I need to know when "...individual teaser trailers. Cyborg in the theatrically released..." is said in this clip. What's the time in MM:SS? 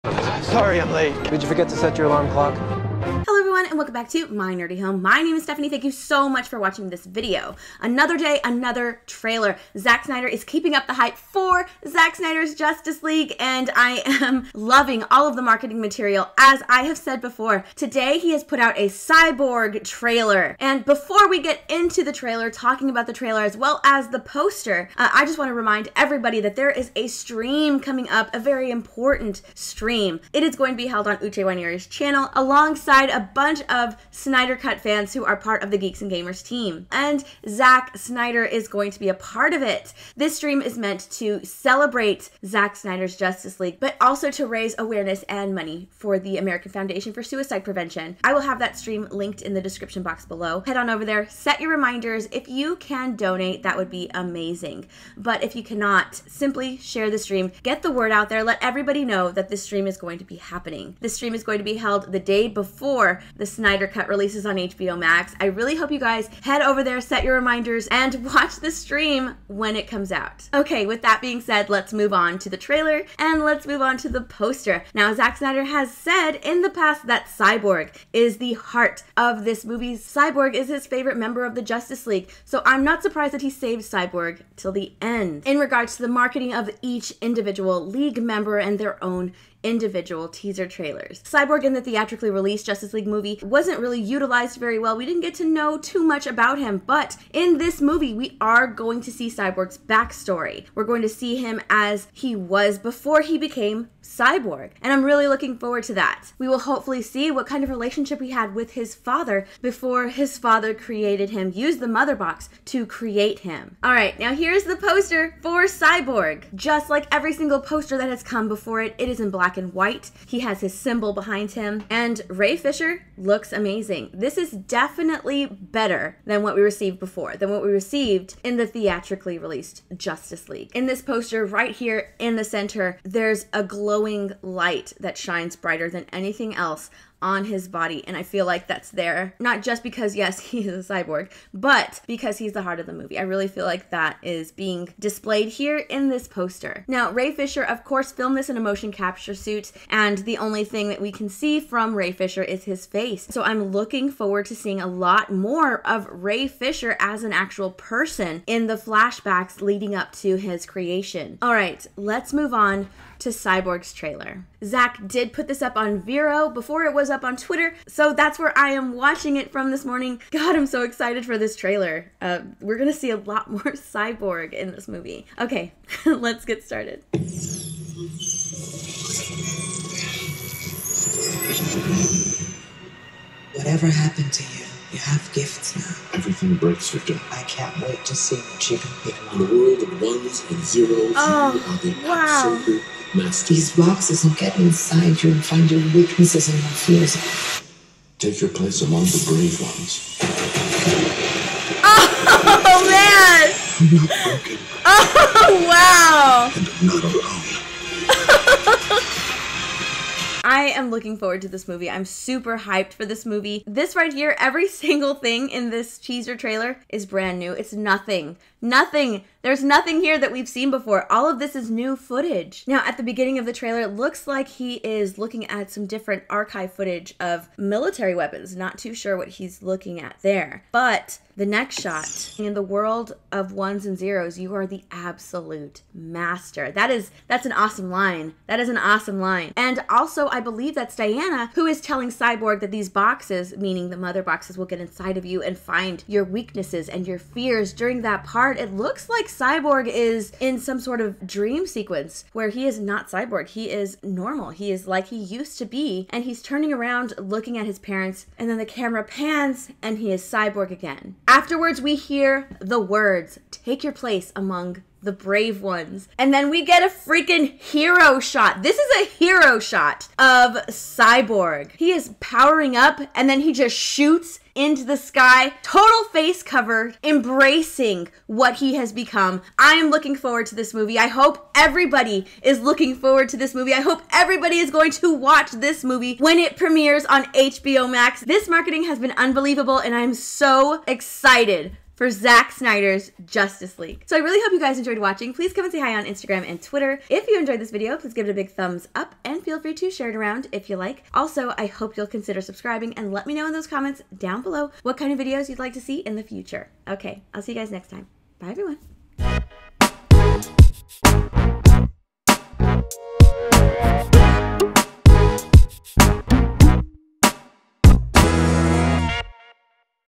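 01:29.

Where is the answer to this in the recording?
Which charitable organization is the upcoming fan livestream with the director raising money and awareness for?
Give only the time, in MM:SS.
00:46.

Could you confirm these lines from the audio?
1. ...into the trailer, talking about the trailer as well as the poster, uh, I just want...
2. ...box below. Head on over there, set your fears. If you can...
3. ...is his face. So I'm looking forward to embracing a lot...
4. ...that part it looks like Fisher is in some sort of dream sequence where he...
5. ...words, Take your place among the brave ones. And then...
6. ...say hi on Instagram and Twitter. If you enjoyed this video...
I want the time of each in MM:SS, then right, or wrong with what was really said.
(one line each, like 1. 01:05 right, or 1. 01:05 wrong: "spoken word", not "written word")
1. 00:21 right
2. 00:50 wrong: "reminders", not "fears"
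3. 02:32 wrong: "seeing", not "embracing"
4. 04:08 wrong: "Cyborg", not "Fisher"
5. 04:22 right
6. 04:55 right.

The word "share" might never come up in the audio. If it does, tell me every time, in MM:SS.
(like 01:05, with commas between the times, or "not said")
00:56, 04:59.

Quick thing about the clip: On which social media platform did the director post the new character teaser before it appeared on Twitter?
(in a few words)
Vero.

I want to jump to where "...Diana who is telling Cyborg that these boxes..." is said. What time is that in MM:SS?
04:00.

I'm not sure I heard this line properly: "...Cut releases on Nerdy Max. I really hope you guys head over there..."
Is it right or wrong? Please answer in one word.
wrong.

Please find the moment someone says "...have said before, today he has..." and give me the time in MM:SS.
00:16.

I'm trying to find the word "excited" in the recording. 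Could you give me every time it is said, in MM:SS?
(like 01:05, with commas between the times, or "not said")
02:50, 04:50.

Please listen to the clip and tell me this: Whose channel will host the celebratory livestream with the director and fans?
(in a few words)
Uche Waniri.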